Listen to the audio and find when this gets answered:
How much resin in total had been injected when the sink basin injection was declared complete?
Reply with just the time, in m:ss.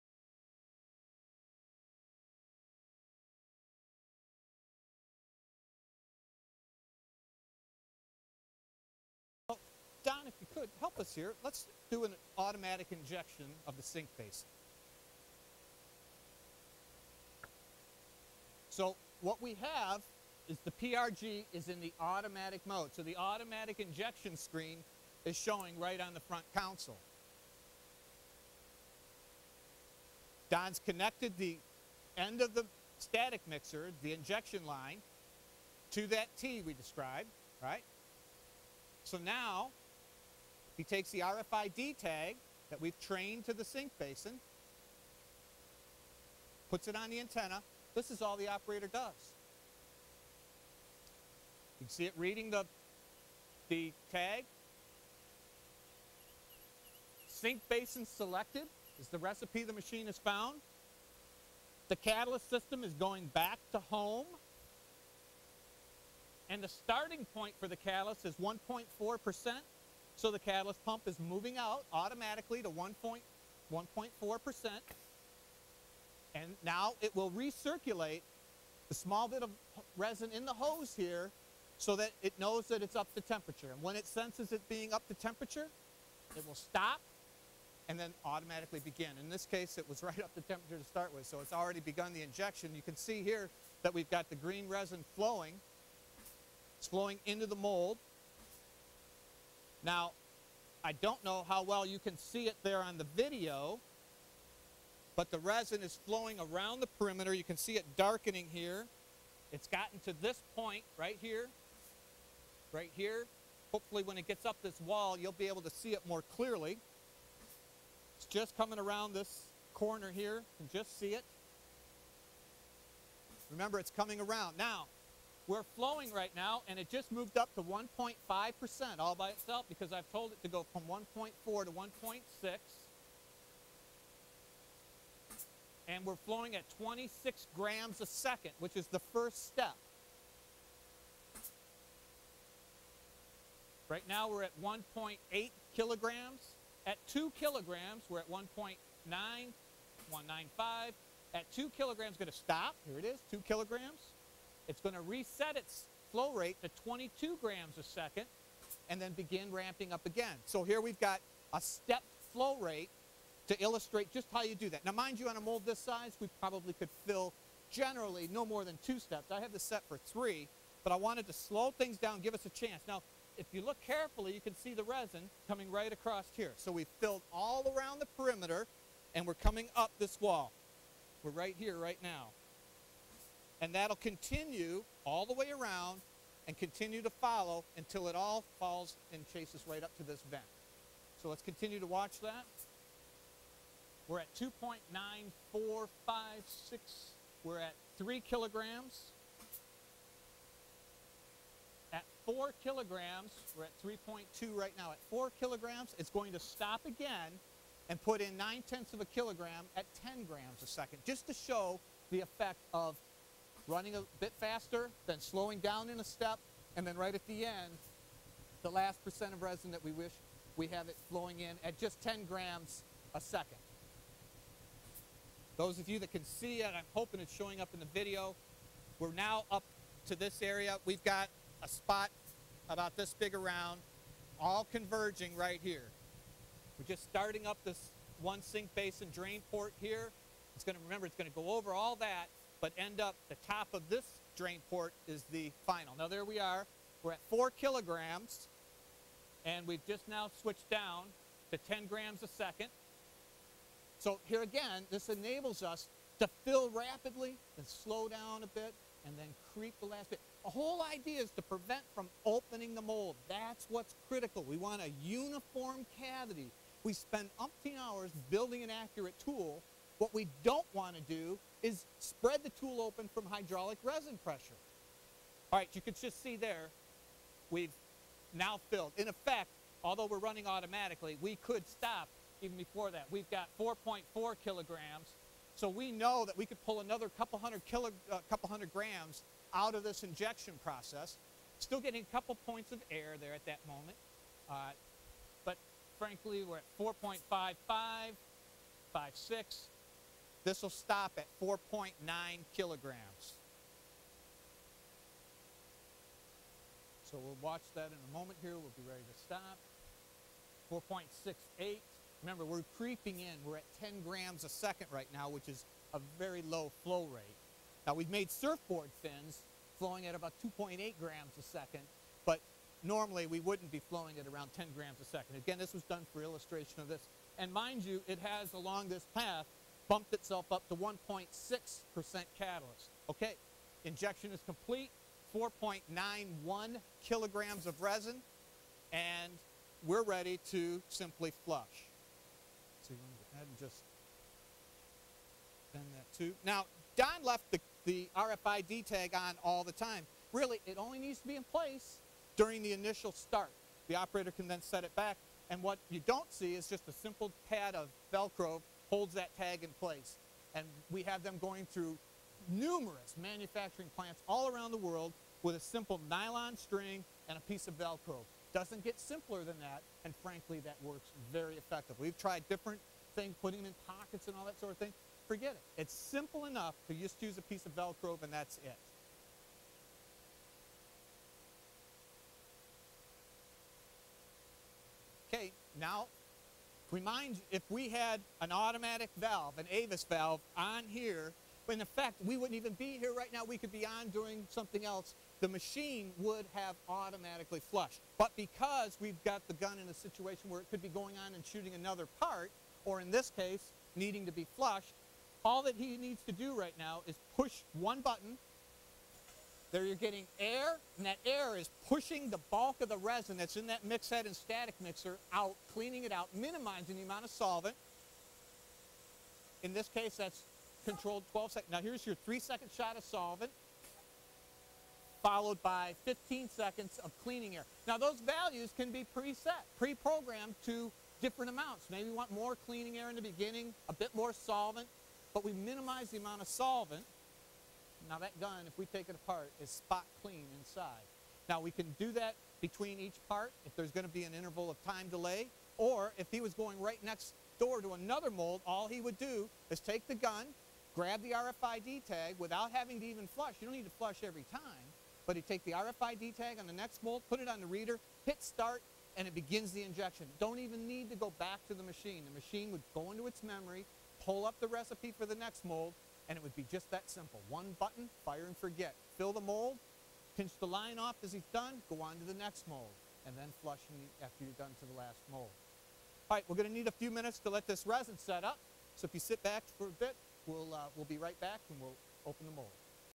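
5:35.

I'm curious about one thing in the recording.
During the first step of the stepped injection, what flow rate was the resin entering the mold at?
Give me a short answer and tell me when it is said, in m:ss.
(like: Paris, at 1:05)
26 grams a second, at 2:16.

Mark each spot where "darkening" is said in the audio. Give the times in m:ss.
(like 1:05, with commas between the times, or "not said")
1:47.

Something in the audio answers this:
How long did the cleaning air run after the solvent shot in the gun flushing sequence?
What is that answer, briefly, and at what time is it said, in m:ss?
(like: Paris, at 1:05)
15 seconds, at 7:06.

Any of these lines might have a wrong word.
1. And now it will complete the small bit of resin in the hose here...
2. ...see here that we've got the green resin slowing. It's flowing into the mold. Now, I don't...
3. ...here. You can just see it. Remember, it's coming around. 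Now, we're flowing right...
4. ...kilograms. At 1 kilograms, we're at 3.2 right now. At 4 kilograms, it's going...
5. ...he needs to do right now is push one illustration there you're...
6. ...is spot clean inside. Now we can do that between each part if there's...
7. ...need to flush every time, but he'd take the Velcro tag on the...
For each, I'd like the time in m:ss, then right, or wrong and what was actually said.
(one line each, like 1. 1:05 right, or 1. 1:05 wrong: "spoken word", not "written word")
1. 1:16 wrong: "recirculate", not "complete"
2. 1:32 wrong: "flowing", not "slowing"
3. 2:00 right
4. 3:18 wrong: "4", not "1"
5. 6:45 wrong: "button", not "illustration"
6. 7:19 right
7. 7:33 wrong: "RFID", not "Velcro".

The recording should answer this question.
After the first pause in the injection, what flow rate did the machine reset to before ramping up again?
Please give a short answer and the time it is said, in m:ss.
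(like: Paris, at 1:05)
22 grams a second, at 2:36.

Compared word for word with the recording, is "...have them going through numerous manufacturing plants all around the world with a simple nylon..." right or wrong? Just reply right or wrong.
right.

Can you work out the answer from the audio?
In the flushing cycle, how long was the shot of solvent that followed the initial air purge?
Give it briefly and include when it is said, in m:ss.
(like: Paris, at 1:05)
3 seconds, at 7:02.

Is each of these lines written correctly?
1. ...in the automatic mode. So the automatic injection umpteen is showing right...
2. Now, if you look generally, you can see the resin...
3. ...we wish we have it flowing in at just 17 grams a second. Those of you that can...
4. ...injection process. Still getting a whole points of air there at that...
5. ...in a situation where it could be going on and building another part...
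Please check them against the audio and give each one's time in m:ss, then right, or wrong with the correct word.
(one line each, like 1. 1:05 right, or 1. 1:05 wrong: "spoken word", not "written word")
1. 0:21 wrong: "screen", not "umpteen"
2. 2:52 wrong: "carefully", not "generally"
3. 3:39 wrong: "10", not "17"
4. 4:50 wrong: "couple", not "whole"
5. 6:39 wrong: "shooting", not "building".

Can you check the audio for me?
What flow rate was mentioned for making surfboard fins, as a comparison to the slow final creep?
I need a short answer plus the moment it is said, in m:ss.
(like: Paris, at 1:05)
2.8 grams a second, at 5:20.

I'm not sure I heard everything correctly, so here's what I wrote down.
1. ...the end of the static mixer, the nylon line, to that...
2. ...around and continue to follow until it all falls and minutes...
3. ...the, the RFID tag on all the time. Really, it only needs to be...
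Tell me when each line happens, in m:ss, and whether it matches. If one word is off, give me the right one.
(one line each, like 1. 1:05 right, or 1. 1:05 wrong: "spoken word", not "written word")
1. 0:31 wrong: "injection", not "nylon"
2. 3:05 wrong: "chases", not "minutes"
3. 5:47 right.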